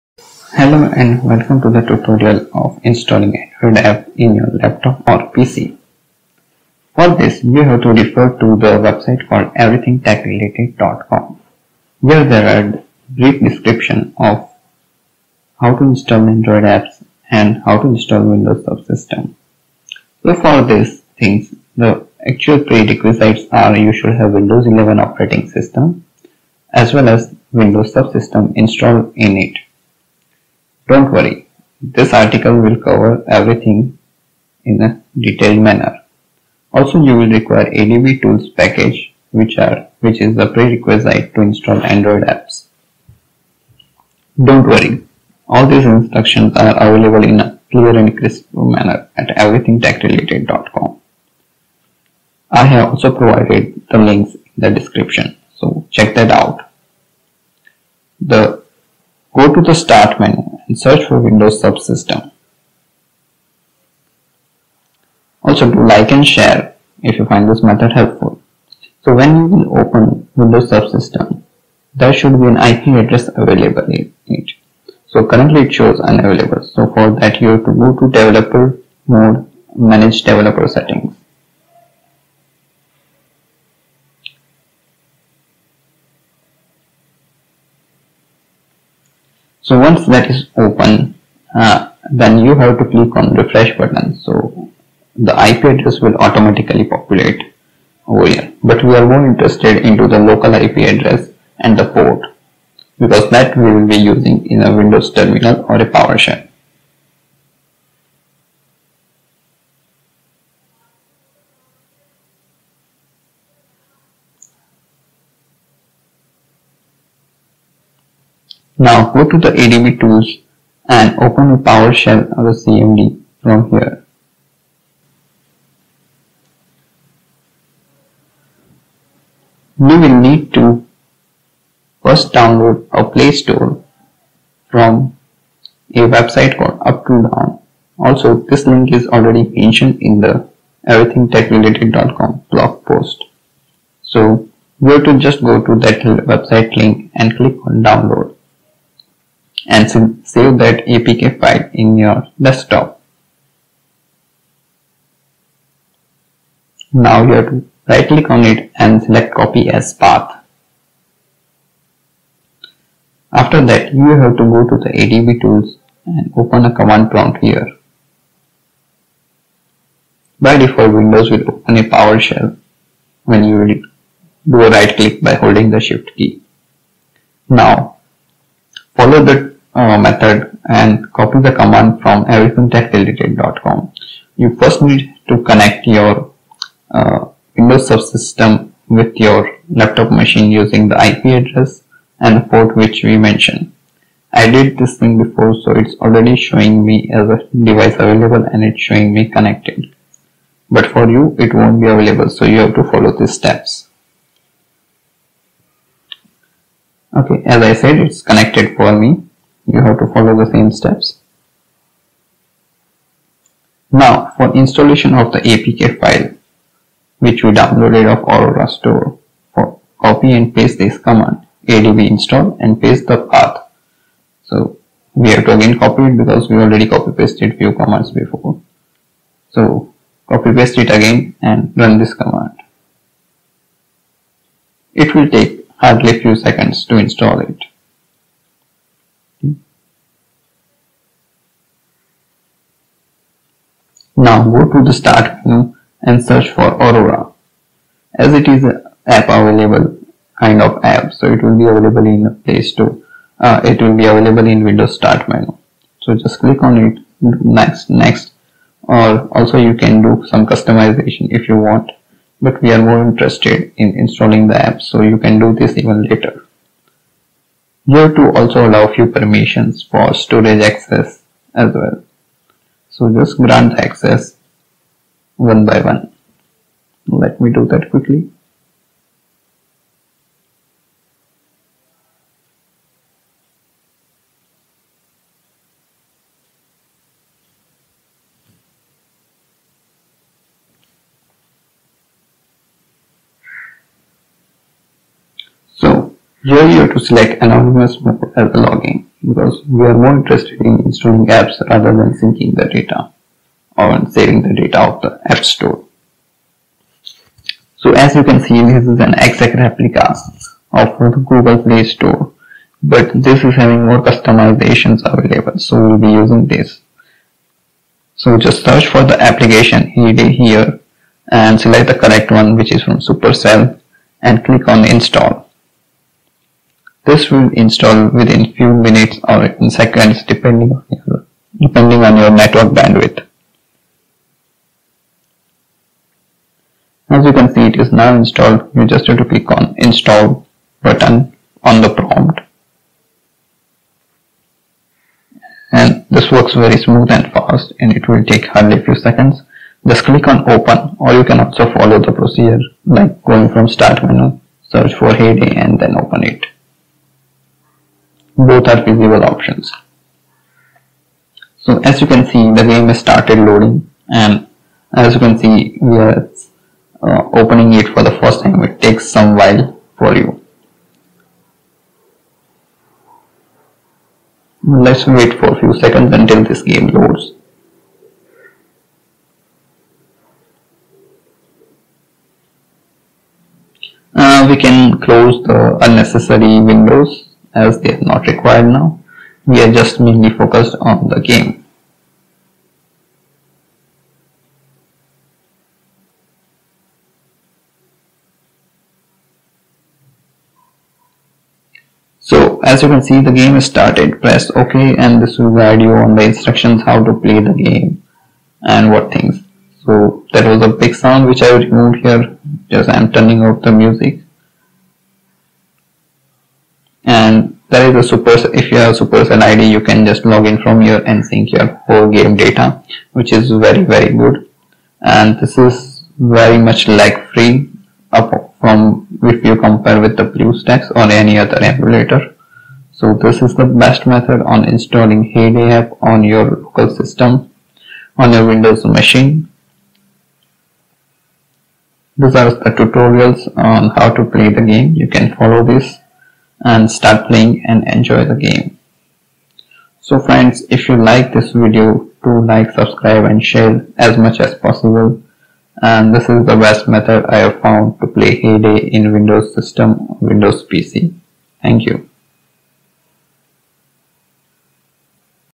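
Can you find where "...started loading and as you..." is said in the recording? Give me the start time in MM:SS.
06:02.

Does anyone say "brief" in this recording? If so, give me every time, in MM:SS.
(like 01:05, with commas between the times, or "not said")
00:13.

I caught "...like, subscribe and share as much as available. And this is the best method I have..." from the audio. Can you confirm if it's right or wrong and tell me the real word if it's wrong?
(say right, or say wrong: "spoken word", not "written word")
wrong: "possible", not "available".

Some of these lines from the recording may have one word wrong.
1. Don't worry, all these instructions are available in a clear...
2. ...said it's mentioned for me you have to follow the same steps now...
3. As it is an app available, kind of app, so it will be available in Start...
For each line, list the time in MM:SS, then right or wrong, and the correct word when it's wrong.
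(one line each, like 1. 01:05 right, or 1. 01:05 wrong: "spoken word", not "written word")
1. 00:44 right
2. 03:27 wrong: "connected", not "mentioned"
3. 04:08 wrong: "Play", not "Start".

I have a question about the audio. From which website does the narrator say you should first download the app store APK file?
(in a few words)
Uptodown.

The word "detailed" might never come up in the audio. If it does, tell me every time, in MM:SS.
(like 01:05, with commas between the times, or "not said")
00:35.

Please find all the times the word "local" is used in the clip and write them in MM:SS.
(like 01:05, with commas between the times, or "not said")
01:40, 07:16.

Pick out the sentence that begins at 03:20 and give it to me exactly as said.
But for you it won't be available so you have to follow these steps.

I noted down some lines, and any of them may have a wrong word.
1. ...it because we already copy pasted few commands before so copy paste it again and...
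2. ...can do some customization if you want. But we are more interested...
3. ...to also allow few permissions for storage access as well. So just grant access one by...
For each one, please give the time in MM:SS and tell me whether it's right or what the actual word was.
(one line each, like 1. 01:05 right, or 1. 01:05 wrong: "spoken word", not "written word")
1. 03:46 right
2. 04:19 right
3. 04:28 right.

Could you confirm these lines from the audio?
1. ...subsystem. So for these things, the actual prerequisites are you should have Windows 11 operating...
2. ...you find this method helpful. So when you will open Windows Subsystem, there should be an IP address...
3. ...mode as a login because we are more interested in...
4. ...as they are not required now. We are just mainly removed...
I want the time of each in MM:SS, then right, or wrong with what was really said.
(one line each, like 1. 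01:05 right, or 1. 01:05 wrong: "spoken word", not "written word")
1. 00:18 right
2. 01:07 right
3. 04:58 right
4. 06:27 wrong: "focused", not "removed".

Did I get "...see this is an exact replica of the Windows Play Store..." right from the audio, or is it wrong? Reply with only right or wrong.
wrong.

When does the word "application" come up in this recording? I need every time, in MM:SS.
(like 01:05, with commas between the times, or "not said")
05:19.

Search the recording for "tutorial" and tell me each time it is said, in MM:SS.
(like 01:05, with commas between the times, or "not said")
00:01, 07:22.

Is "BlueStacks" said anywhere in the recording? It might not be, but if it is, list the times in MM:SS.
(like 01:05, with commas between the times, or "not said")
07:10.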